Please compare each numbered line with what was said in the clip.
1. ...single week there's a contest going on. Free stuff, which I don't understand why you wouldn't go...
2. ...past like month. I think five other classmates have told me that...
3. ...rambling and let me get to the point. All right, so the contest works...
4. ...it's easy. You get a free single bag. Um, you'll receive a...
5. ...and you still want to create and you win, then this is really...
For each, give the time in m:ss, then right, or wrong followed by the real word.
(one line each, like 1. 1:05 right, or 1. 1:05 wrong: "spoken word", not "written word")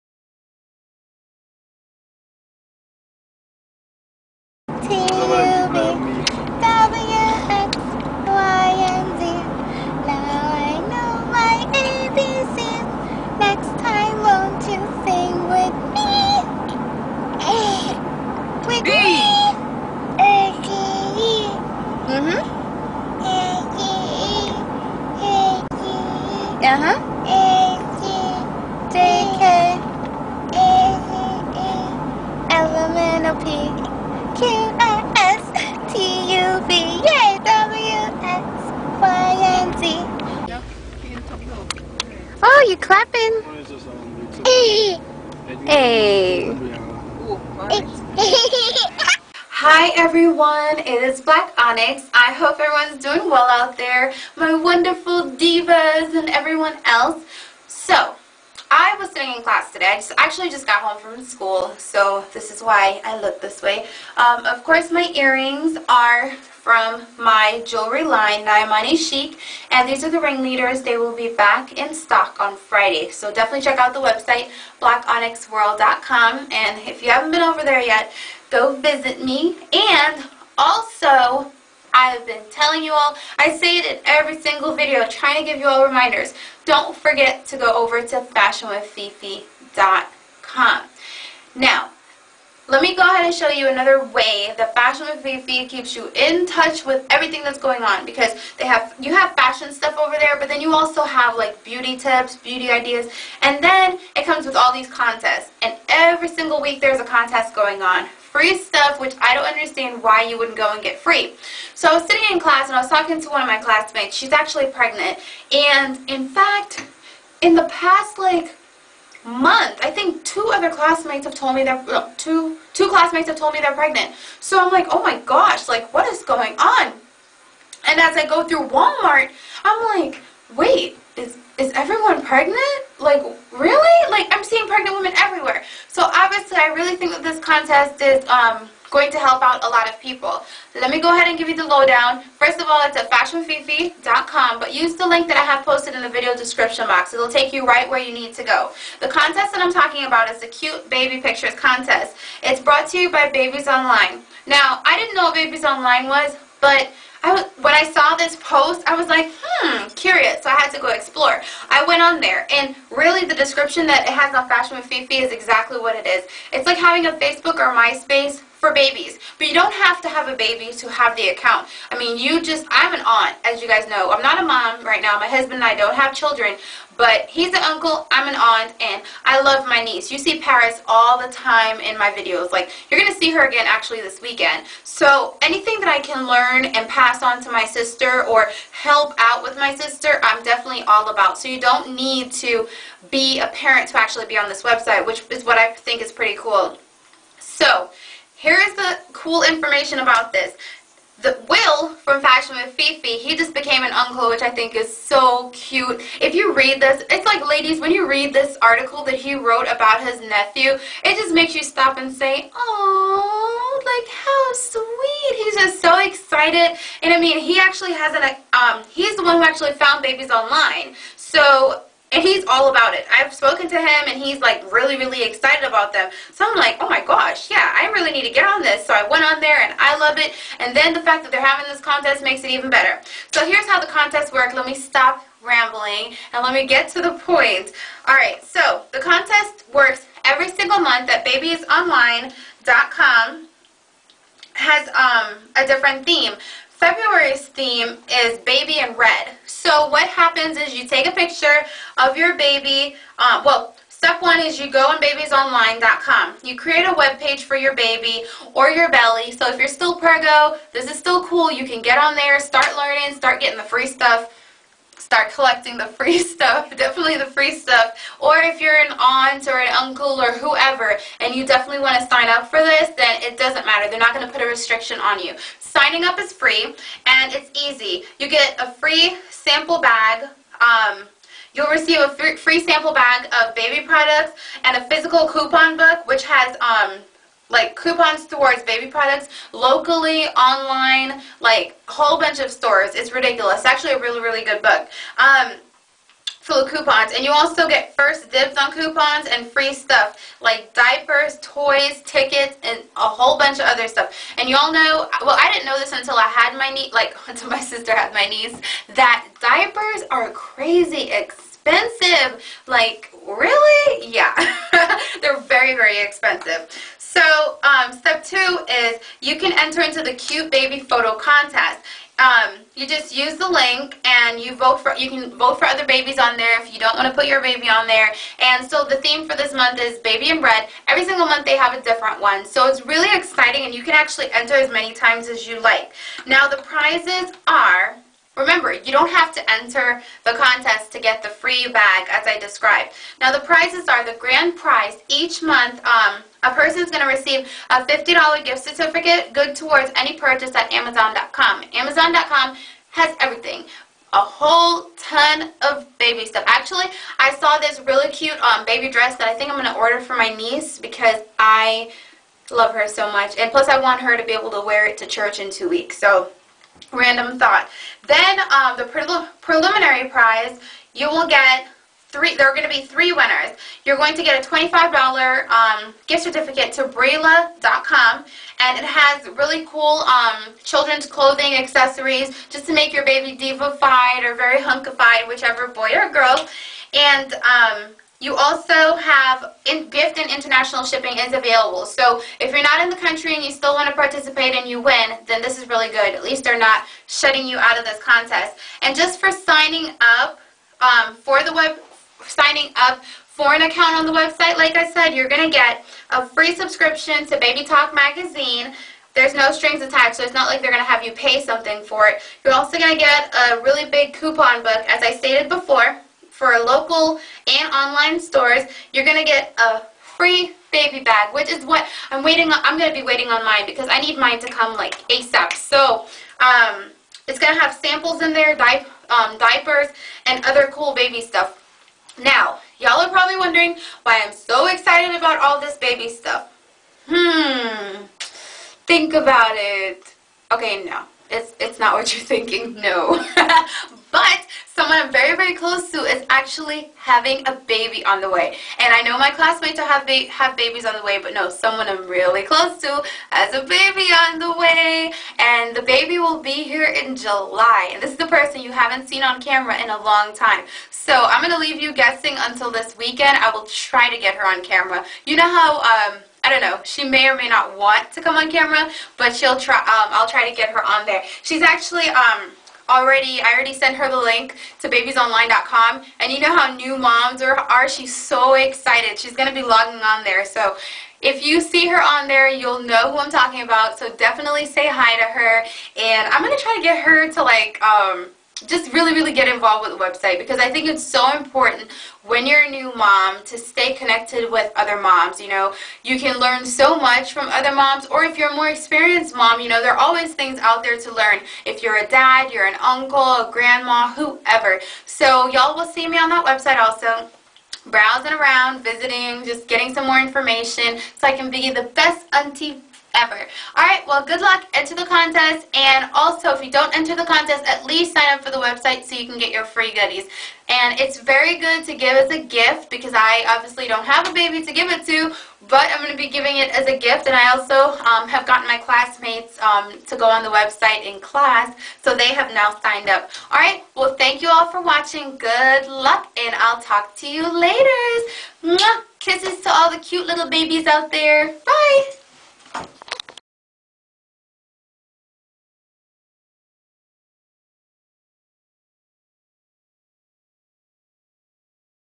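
1. 1:46 right
2. 1:57 wrong: "two", not "five"
3. 3:55 right
4. 4:37 wrong: "sample", not "single"
5. 6:33 wrong: "participate", not "create".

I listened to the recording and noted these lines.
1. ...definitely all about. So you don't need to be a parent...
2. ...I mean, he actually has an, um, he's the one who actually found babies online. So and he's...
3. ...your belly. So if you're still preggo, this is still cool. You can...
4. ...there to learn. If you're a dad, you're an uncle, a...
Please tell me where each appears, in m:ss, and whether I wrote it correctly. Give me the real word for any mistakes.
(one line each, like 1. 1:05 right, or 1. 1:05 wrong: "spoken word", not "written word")
1. 3:10 right
2. 3:37 right
3. 4:18 right
4. 8:20 right.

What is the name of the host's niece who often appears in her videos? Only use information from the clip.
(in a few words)
Paris.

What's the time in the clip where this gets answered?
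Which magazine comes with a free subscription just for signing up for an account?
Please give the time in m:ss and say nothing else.
6:47.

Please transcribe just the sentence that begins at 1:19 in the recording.
And also, I've been telling you all, I say it in every single video, trying to give you all reminders.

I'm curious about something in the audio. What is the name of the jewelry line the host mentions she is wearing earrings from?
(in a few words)
Naimani Chic.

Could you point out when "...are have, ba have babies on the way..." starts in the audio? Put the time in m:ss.
7:29.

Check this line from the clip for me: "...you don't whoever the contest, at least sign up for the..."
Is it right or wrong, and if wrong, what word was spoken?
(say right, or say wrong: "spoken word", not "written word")
wrong: "enter", not "whoever".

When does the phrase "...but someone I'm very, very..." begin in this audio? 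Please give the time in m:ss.
7:24.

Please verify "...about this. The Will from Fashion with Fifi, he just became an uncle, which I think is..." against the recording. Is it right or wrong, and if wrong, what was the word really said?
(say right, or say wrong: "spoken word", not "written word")
right.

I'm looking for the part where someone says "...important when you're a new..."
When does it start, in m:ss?
8:11.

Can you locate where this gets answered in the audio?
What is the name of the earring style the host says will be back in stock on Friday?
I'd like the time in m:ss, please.
1:10.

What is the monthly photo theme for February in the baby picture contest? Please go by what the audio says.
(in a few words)
baby in red.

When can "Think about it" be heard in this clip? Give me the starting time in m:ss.
7:18.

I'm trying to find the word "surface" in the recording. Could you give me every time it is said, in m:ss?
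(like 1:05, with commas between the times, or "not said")
not said.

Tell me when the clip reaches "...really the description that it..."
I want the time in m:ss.
2:42.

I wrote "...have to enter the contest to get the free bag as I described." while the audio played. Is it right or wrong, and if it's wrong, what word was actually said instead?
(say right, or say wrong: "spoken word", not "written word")
right.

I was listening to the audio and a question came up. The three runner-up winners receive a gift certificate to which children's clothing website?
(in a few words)
Brayla.com.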